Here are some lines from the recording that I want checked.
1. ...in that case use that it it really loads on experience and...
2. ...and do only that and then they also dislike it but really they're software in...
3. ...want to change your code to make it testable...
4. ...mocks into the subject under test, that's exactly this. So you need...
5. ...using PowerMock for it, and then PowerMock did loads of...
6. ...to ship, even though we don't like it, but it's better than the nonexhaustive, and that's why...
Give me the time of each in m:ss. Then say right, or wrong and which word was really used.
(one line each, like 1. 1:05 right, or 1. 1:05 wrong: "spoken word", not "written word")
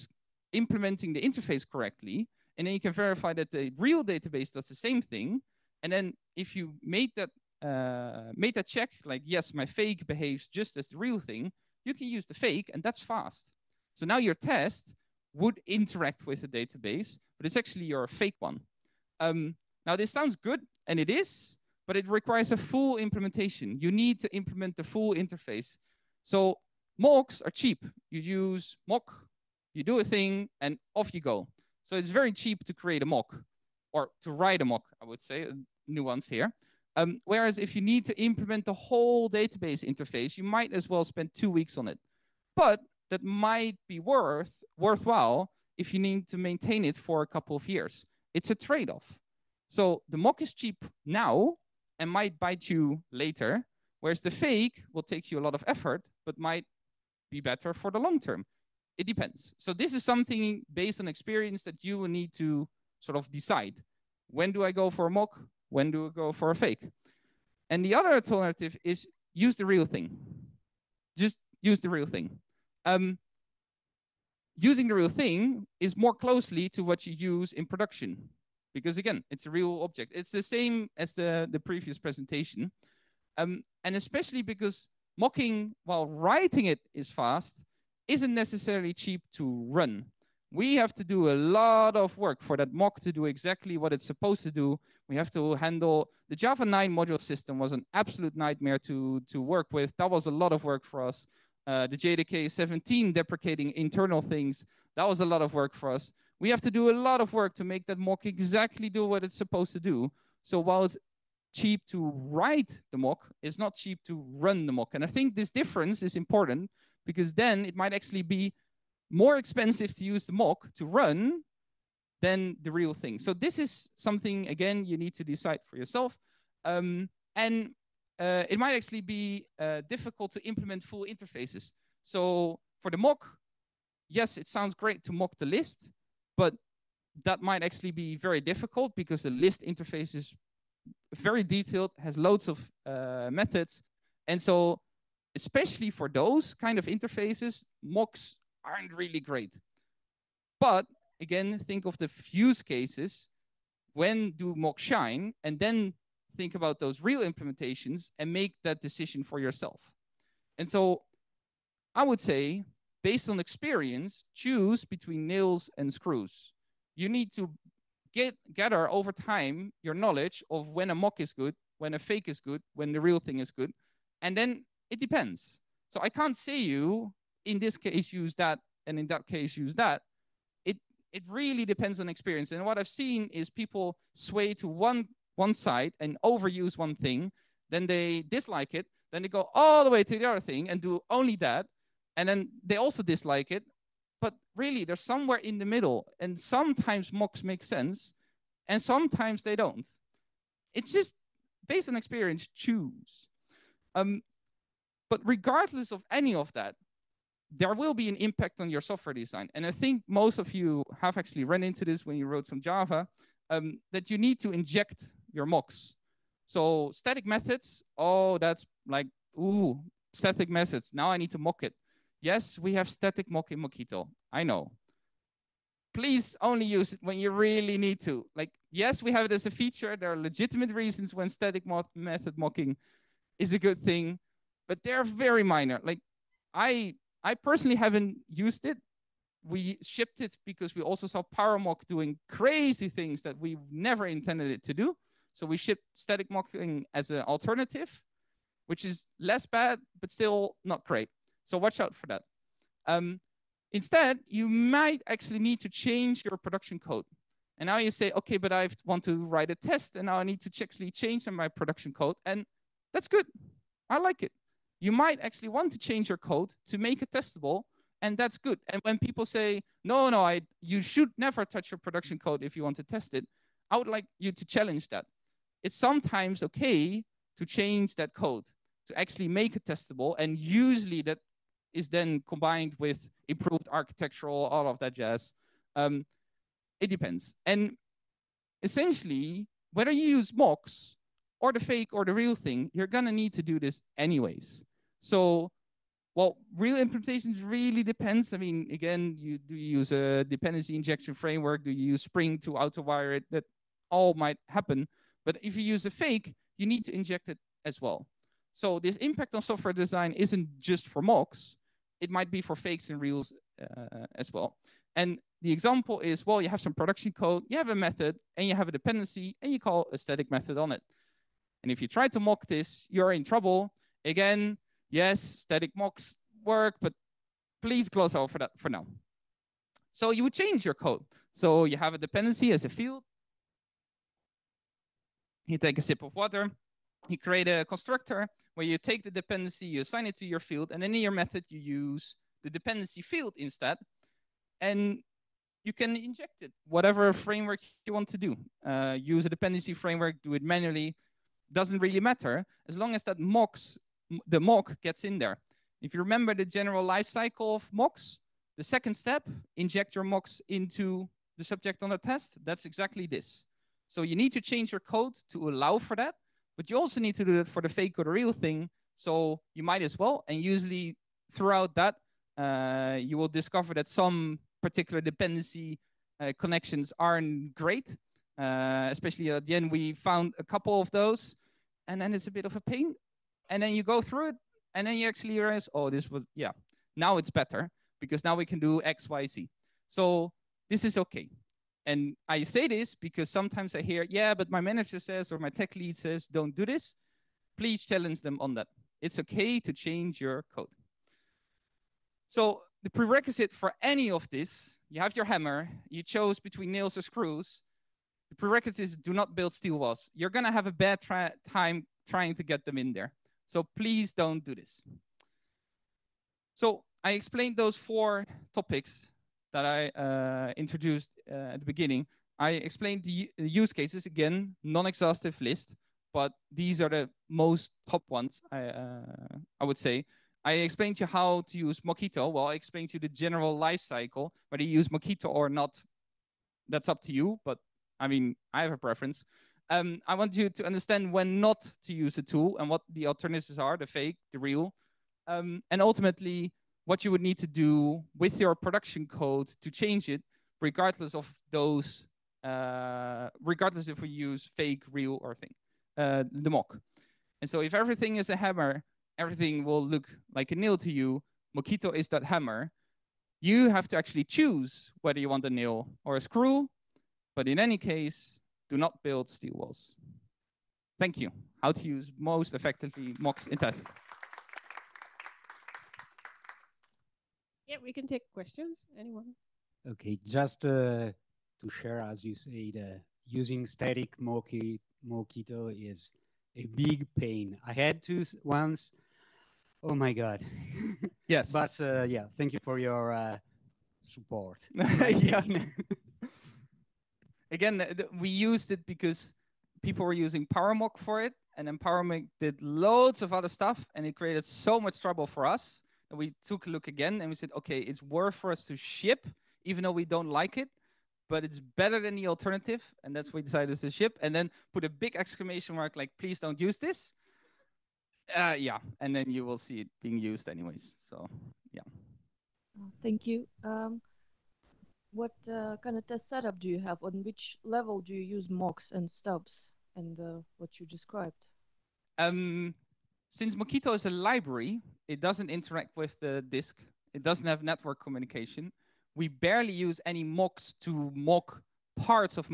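1. 2:58 wrong: "depends", not "loads"
2. 3:10 wrong: "somewhere", not "software"
3. 4:25 right
4. 6:00 right
5. 8:20 right
6. 8:28 wrong: "alternative", not "nonexhaustive".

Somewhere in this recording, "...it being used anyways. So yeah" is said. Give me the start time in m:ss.
8:39.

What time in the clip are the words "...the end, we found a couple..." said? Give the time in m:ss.
6:19.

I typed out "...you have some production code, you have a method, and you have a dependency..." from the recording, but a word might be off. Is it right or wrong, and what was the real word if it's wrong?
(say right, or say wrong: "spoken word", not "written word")
right.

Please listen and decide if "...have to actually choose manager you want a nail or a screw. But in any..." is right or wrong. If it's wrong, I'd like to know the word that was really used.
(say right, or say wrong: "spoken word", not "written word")
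wrong: "whether", not "manager".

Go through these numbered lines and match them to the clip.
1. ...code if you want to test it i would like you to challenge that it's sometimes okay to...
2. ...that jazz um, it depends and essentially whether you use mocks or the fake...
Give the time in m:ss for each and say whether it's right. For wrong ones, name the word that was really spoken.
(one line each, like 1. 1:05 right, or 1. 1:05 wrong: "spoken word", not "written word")
1. 4:32 right
2. 4:44 right.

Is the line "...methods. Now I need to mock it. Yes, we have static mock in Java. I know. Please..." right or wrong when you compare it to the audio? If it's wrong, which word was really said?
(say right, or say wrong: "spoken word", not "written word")
wrong: "Mockito", not "Java".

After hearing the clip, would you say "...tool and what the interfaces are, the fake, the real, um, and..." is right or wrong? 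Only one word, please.
wrong.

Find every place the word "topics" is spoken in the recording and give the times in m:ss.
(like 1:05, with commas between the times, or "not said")
6:58.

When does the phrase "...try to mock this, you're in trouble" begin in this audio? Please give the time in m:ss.
5:21.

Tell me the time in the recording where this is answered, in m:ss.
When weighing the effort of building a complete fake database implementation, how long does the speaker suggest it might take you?
0:41.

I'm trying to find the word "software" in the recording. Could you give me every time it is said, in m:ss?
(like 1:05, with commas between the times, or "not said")
3:28, 5:09.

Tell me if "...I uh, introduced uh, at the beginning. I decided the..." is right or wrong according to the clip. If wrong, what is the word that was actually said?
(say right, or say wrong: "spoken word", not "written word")
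wrong: "explained", not "decided".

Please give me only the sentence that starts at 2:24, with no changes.
And so especially for those kind of interfaces, mocks aren't really great.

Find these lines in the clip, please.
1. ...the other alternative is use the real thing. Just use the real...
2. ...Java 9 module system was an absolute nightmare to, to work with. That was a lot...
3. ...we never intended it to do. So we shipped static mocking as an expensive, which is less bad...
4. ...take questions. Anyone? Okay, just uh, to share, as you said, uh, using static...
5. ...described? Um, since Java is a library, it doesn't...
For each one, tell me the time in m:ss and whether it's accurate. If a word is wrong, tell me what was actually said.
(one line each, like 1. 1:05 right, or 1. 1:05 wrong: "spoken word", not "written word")
1. 1:07 right
2. 1:36 right
3. 4:03 wrong: "alternative", not "expensive"
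4. 7:58 right
5. 8:50 wrong: "Mockito", not "Java".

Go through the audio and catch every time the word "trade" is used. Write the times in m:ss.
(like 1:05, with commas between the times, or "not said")
0:48.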